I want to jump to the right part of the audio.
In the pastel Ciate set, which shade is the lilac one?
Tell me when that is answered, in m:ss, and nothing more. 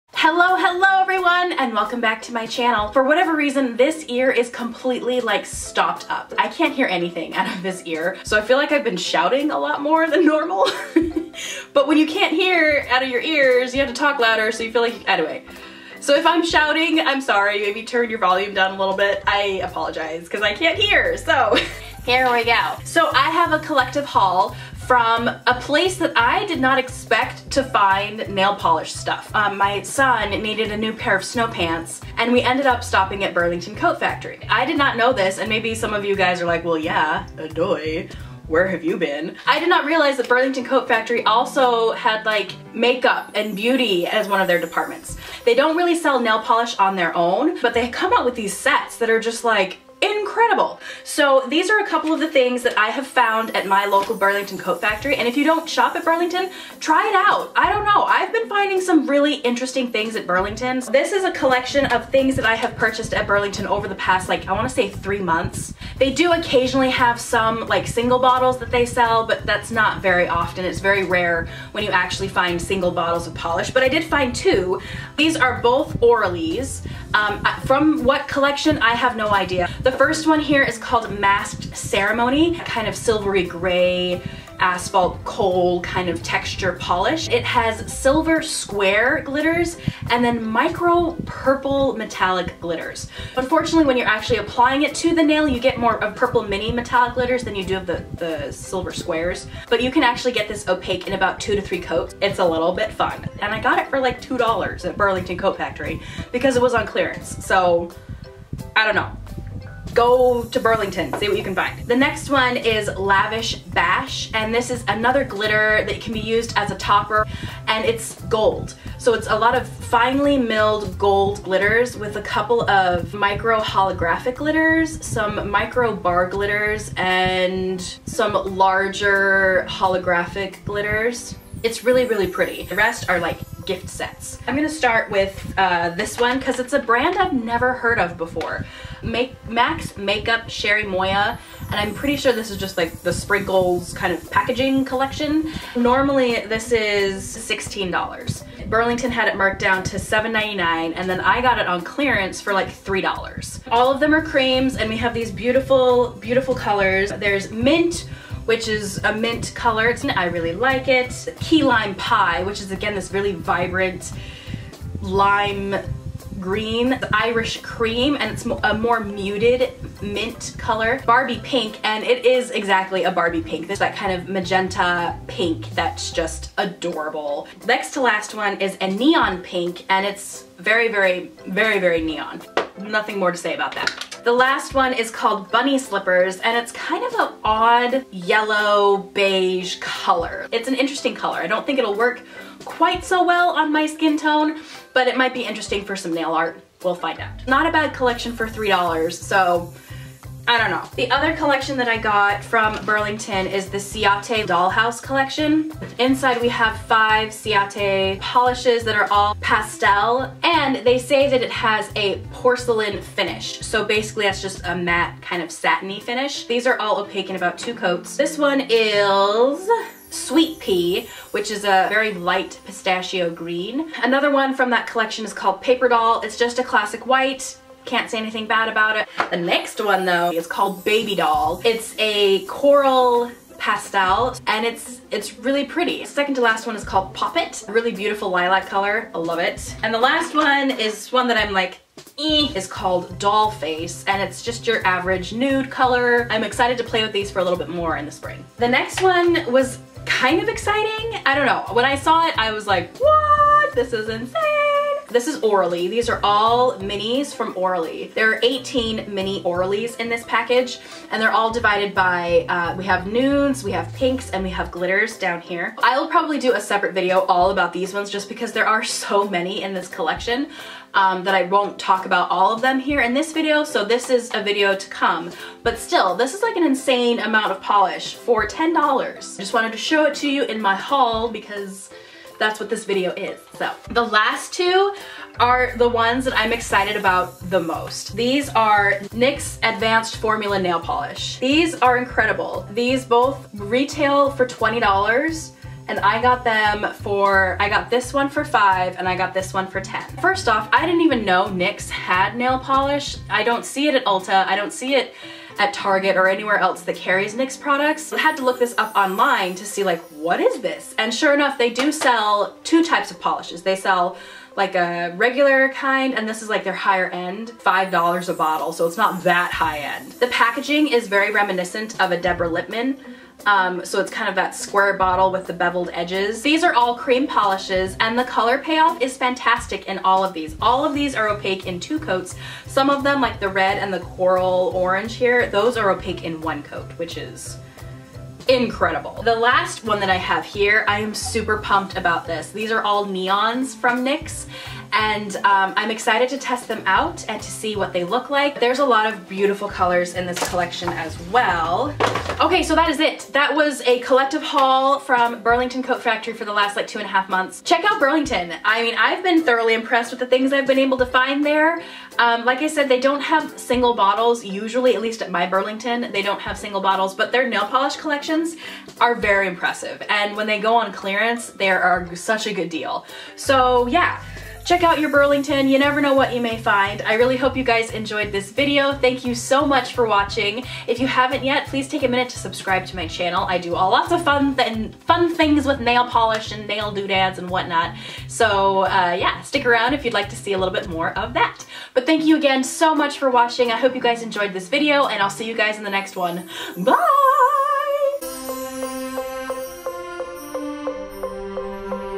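3:57.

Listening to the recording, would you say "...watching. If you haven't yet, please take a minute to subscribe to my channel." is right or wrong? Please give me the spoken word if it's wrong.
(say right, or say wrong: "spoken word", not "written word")
right.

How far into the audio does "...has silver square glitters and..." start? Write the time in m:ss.
1:27.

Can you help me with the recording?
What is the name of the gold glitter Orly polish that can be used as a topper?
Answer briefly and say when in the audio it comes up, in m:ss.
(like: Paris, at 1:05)
Lavish Bash, at 1:52.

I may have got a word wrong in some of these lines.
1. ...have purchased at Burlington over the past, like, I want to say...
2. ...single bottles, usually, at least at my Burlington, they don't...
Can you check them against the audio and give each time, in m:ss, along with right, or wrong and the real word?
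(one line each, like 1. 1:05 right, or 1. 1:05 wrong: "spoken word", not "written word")
1. 1:02 right
2. 6:03 right.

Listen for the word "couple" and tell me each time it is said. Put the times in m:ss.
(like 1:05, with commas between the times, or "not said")
0:51, 2:02.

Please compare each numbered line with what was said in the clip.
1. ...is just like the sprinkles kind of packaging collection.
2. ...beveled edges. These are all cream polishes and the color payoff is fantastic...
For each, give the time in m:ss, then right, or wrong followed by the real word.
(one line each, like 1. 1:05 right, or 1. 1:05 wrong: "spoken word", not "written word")
1. 2:22 right
2. 5:25 right.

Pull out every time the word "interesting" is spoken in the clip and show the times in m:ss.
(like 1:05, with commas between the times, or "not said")
0:59, 3:10, 3:15.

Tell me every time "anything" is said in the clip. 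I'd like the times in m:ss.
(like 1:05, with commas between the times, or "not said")
0:06, 3:48.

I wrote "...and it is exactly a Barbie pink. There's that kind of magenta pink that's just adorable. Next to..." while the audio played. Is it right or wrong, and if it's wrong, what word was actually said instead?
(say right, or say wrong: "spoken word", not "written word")
right.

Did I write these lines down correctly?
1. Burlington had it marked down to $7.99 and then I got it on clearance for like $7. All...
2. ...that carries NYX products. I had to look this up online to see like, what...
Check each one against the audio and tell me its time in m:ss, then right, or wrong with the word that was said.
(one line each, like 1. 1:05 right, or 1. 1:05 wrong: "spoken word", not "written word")
1. 2:28 wrong: "3", not "7"
2. 5:06 right.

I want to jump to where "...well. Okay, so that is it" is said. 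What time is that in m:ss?
5:51.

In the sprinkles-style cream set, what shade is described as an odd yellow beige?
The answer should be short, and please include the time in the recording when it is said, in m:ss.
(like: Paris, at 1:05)
Bunny Slippers, at 3:05.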